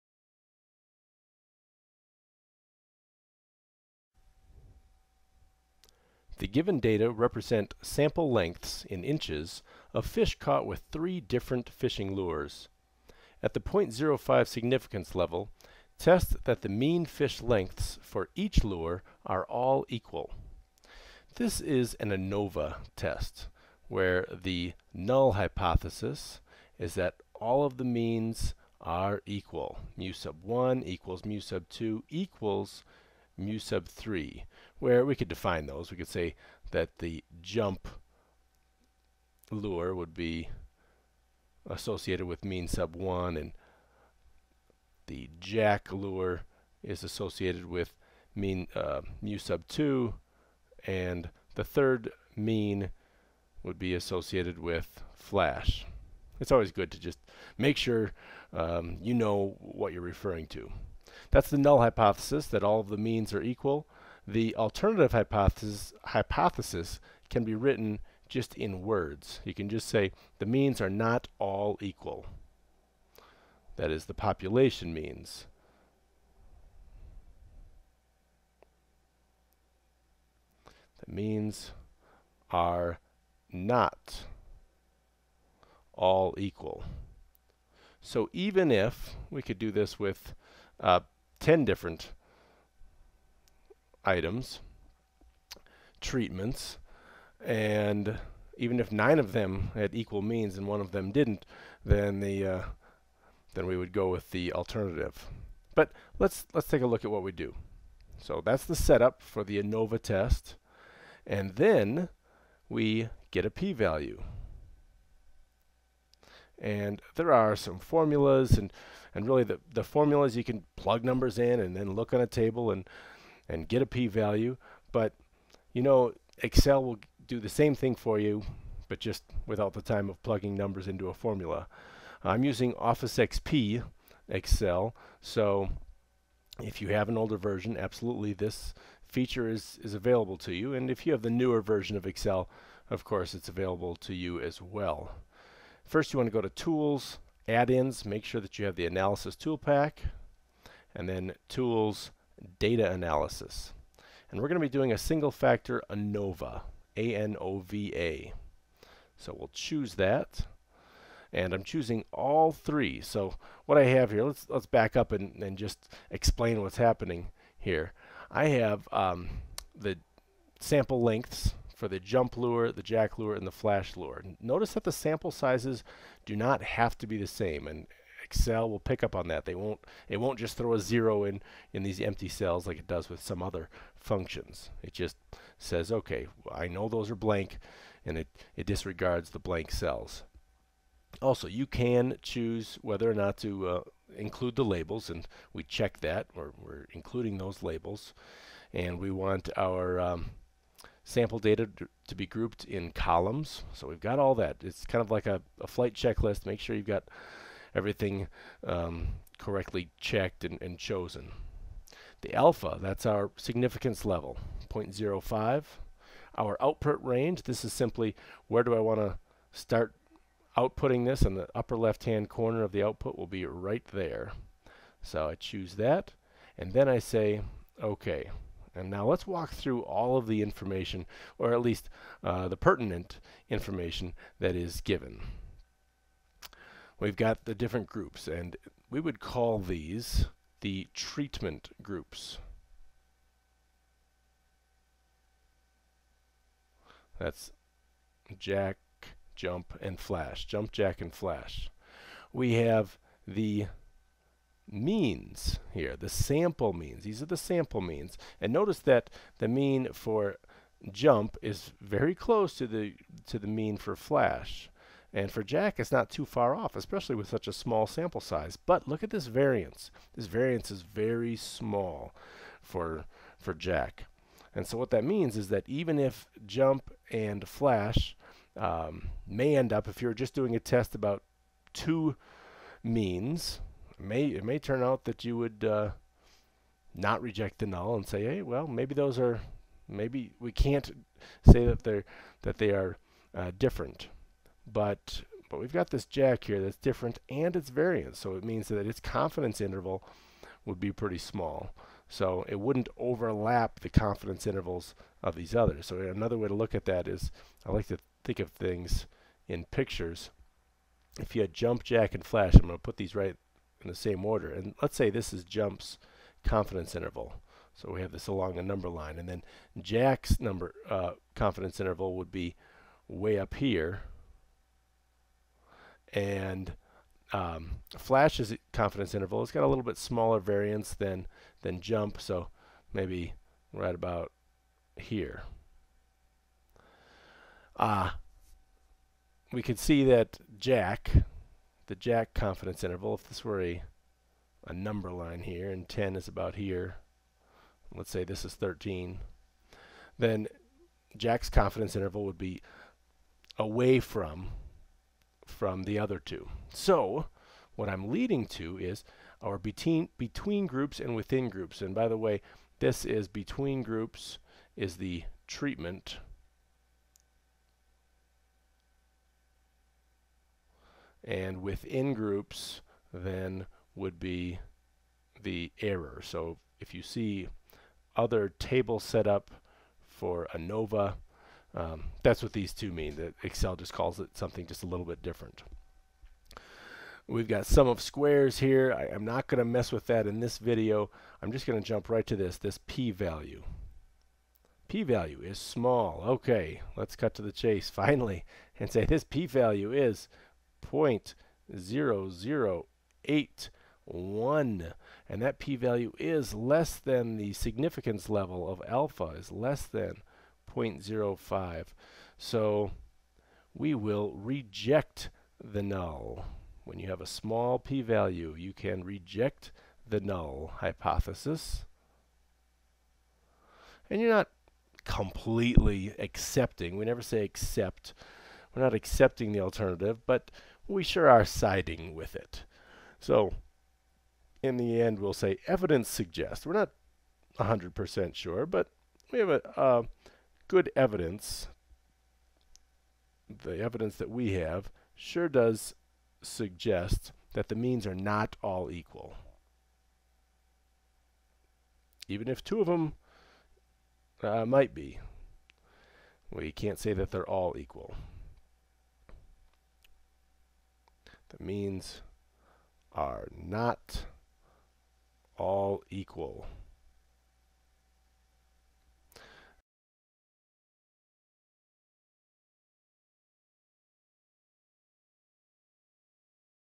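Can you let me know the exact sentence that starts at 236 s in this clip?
We've got the different groups, and we would call these the treatment groups.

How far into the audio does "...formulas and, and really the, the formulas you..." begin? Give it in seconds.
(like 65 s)
117 s.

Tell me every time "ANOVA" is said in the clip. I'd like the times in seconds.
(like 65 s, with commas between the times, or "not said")
22 s, 109 s, 155 s, 380 s.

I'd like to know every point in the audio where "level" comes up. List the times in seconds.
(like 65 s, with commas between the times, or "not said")
15 s, 214 s, 408 s.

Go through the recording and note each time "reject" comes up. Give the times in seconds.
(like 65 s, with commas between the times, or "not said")
287 s, 414 s, 419 s.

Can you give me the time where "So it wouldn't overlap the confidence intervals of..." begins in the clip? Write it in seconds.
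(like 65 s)
302 s.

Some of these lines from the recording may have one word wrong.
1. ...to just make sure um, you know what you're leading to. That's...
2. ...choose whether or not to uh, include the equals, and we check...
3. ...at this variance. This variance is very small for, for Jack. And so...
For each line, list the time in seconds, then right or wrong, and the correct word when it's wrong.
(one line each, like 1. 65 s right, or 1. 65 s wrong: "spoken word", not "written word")
1. 56 s wrong: "referring", not "leading"
2. 192 s wrong: "labels", not "equals"
3. 269 s right.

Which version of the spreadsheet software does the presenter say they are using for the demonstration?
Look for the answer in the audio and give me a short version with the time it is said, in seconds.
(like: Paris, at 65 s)
Office XP, at 132 s.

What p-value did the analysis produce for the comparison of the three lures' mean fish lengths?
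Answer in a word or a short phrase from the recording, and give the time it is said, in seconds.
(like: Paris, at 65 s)
0.0081, at 400 s.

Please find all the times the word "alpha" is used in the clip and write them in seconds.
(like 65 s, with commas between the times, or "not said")
212 s, 408 s.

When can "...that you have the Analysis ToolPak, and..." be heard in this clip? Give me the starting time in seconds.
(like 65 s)
148 s.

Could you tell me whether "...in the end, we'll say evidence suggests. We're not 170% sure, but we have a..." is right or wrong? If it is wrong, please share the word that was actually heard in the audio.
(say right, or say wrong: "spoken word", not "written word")
wrong: "100", not "170".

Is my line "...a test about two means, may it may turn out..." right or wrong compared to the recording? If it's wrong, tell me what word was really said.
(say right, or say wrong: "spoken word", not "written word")
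right.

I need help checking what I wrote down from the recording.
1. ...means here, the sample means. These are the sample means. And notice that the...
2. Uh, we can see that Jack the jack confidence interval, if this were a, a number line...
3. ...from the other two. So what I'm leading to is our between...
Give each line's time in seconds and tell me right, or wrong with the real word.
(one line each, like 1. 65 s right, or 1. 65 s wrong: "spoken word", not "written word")
1. 254 s right
2. 337 s right
3. 355 s right.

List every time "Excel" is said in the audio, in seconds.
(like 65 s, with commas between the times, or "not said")
126 s, 134 s, 142 s, 178 s, 383 s.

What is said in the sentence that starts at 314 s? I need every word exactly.
And let's say this is Jump's confidence interval.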